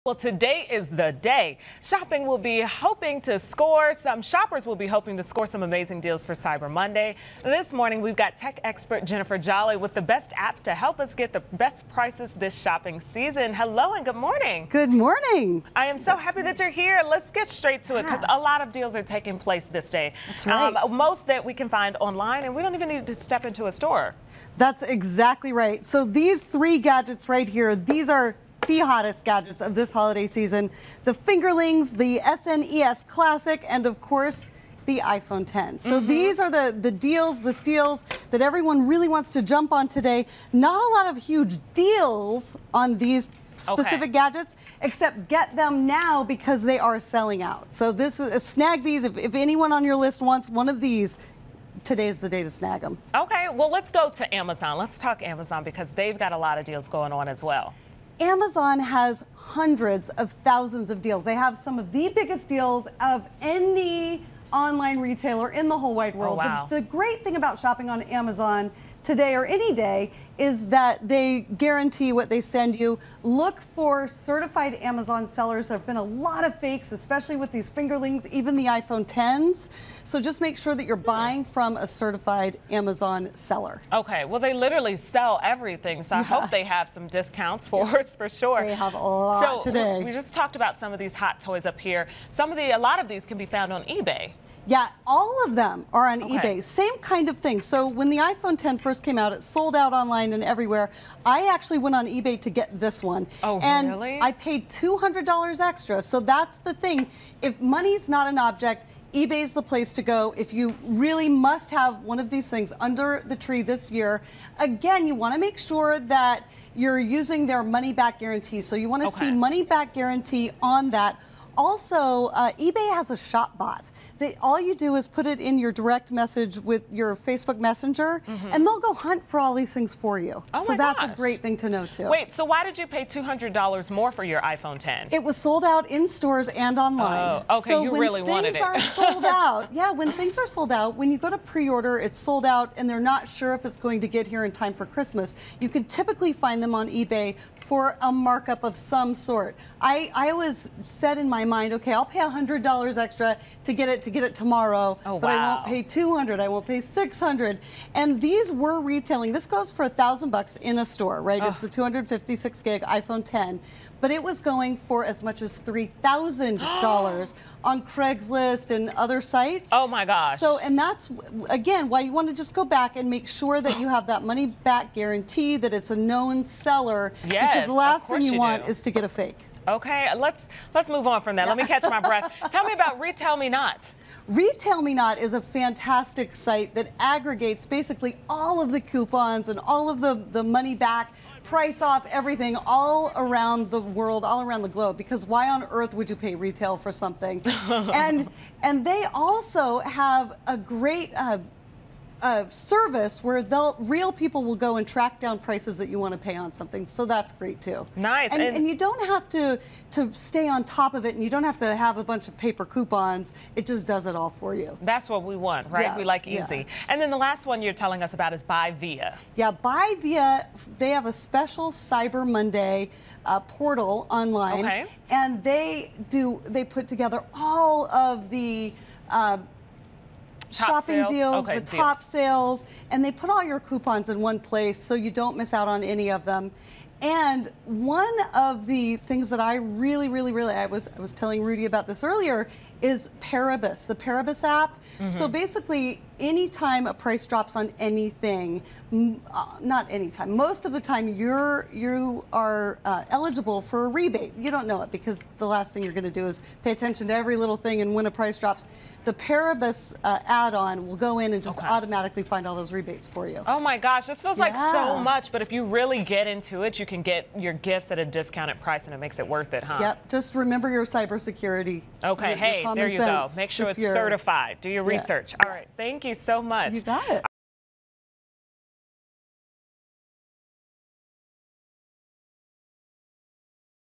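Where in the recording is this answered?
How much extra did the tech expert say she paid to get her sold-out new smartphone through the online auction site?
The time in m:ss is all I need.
1:44.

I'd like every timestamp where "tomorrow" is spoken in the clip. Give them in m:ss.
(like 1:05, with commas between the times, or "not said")
2:34.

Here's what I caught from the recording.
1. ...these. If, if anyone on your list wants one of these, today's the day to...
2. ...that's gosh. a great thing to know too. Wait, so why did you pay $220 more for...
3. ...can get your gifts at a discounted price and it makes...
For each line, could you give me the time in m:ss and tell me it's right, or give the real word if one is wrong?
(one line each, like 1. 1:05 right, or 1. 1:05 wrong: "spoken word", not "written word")
1. 0:48 right
2. 2:10 wrong: "200", not "220"
3. 4:26 right.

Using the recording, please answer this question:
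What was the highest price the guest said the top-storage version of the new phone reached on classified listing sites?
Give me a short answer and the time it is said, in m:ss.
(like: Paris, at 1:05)
$3,000, at 2:45.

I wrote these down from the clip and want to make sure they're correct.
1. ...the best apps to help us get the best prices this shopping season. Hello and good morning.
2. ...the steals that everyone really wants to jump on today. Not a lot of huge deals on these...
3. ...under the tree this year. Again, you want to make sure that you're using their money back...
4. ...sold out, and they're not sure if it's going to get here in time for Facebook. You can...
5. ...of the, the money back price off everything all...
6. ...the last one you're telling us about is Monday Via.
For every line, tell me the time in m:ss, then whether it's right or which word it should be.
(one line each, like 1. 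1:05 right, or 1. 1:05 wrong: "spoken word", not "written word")
1. 0:09 right
2. 0:37 right
3. 1:52 right
4. 2:22 wrong: "Christmas", not "Facebook"
5. 3:09 right
6. 3:37 wrong: "Buy", not "Monday".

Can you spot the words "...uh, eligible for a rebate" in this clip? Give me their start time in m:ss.
4:12.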